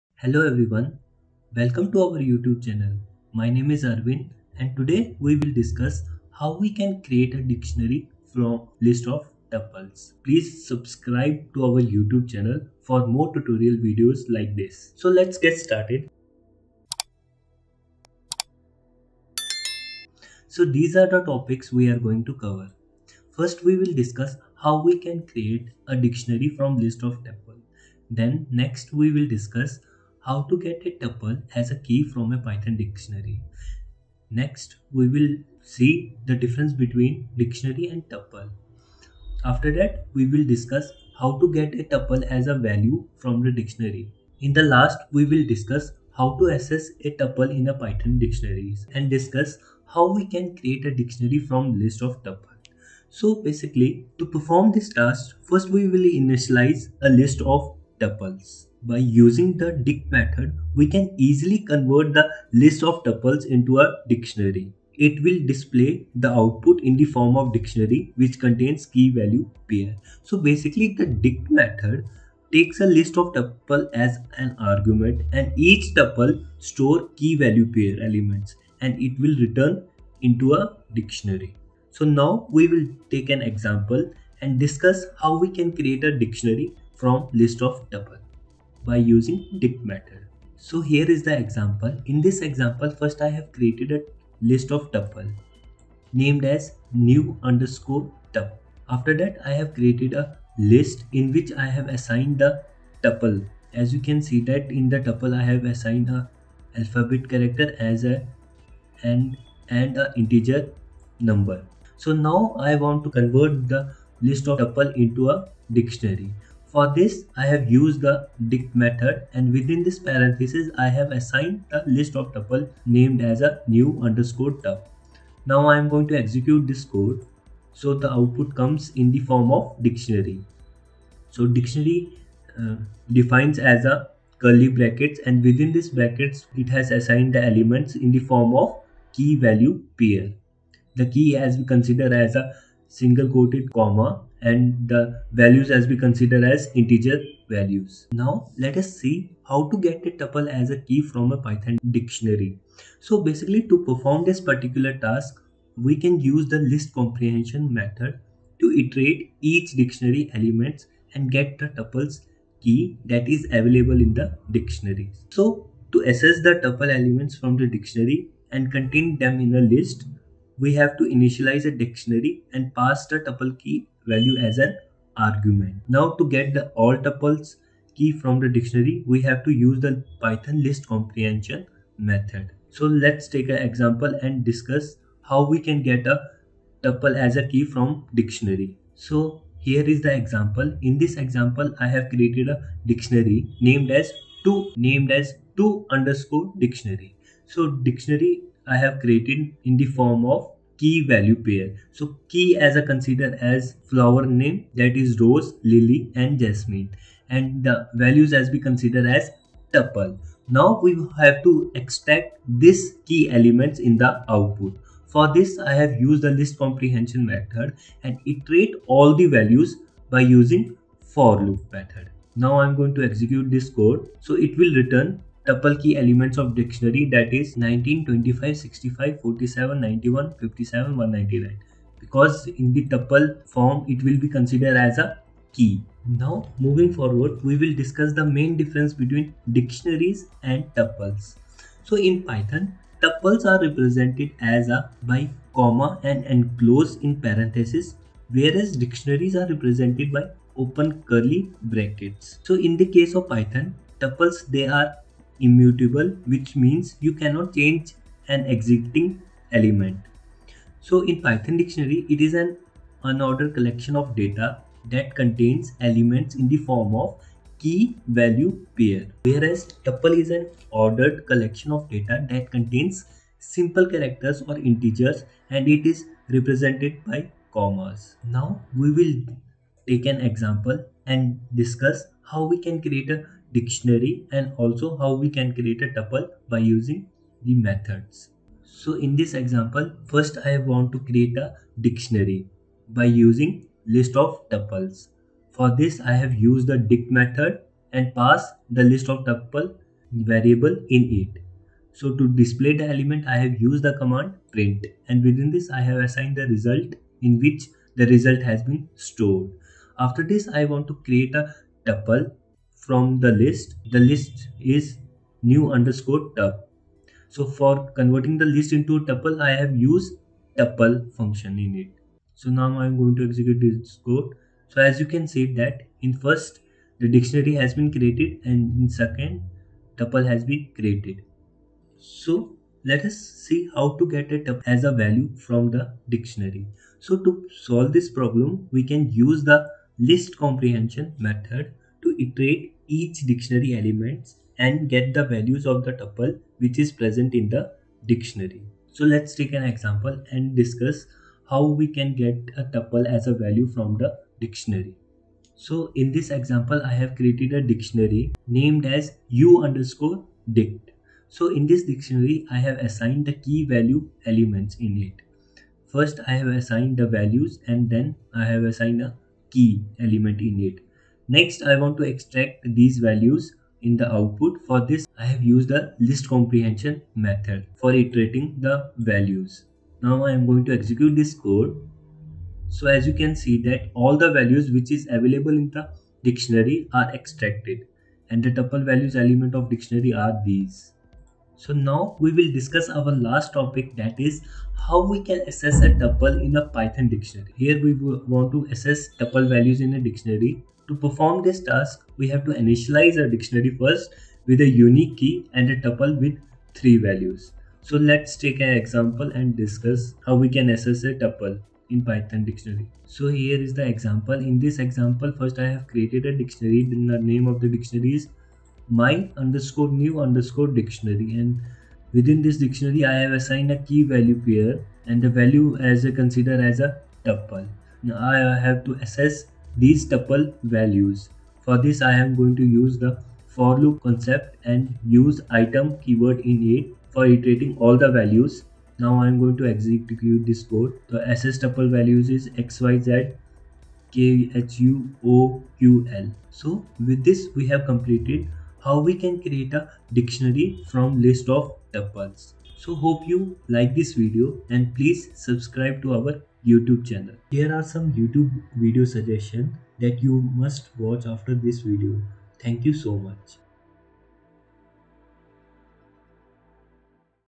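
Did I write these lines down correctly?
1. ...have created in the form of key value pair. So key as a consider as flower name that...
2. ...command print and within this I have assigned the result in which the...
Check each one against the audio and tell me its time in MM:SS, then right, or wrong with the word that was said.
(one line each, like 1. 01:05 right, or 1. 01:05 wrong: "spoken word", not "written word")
1. 03:18 right
2. 05:03 right.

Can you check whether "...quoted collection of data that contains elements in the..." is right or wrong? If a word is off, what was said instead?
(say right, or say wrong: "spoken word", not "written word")
wrong: "unordered", not "quoted".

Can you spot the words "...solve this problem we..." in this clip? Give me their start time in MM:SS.
05:37.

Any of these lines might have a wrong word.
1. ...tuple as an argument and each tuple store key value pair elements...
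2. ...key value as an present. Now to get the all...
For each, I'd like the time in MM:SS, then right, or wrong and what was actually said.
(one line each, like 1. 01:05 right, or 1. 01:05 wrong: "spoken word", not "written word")
1. 01:13 right
2. 02:53 wrong: "argument", not "present".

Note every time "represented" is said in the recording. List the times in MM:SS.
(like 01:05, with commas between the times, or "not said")
04:03, 04:09, 04:36.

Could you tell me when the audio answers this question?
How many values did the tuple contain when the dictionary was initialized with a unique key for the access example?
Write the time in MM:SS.
06:46.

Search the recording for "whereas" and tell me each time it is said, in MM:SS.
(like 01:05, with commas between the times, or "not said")
04:08, 04:29.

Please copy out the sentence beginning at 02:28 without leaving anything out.
Now let us see how to get a tuple as a key from a Python dictionary.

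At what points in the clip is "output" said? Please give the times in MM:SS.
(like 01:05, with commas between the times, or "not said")
01:06, 02:08, 03:34, 06:14.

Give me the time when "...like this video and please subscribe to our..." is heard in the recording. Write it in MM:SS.
07:33.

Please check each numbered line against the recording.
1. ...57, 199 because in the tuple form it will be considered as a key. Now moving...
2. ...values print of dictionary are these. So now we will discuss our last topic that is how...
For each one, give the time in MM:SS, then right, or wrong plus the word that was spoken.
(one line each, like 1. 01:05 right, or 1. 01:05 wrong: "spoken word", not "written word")
1. 03:50 right
2. 06:28 wrong: "element", not "print".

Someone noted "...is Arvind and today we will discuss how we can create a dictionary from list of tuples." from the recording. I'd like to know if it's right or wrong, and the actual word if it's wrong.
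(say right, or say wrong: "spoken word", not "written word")
right.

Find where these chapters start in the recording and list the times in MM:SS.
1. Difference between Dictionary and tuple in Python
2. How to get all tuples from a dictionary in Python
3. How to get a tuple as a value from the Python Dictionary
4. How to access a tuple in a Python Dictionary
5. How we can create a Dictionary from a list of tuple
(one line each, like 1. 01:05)
1. 04:04
2. 02:29
3. 05:33
4. 06:34
5. 00:49.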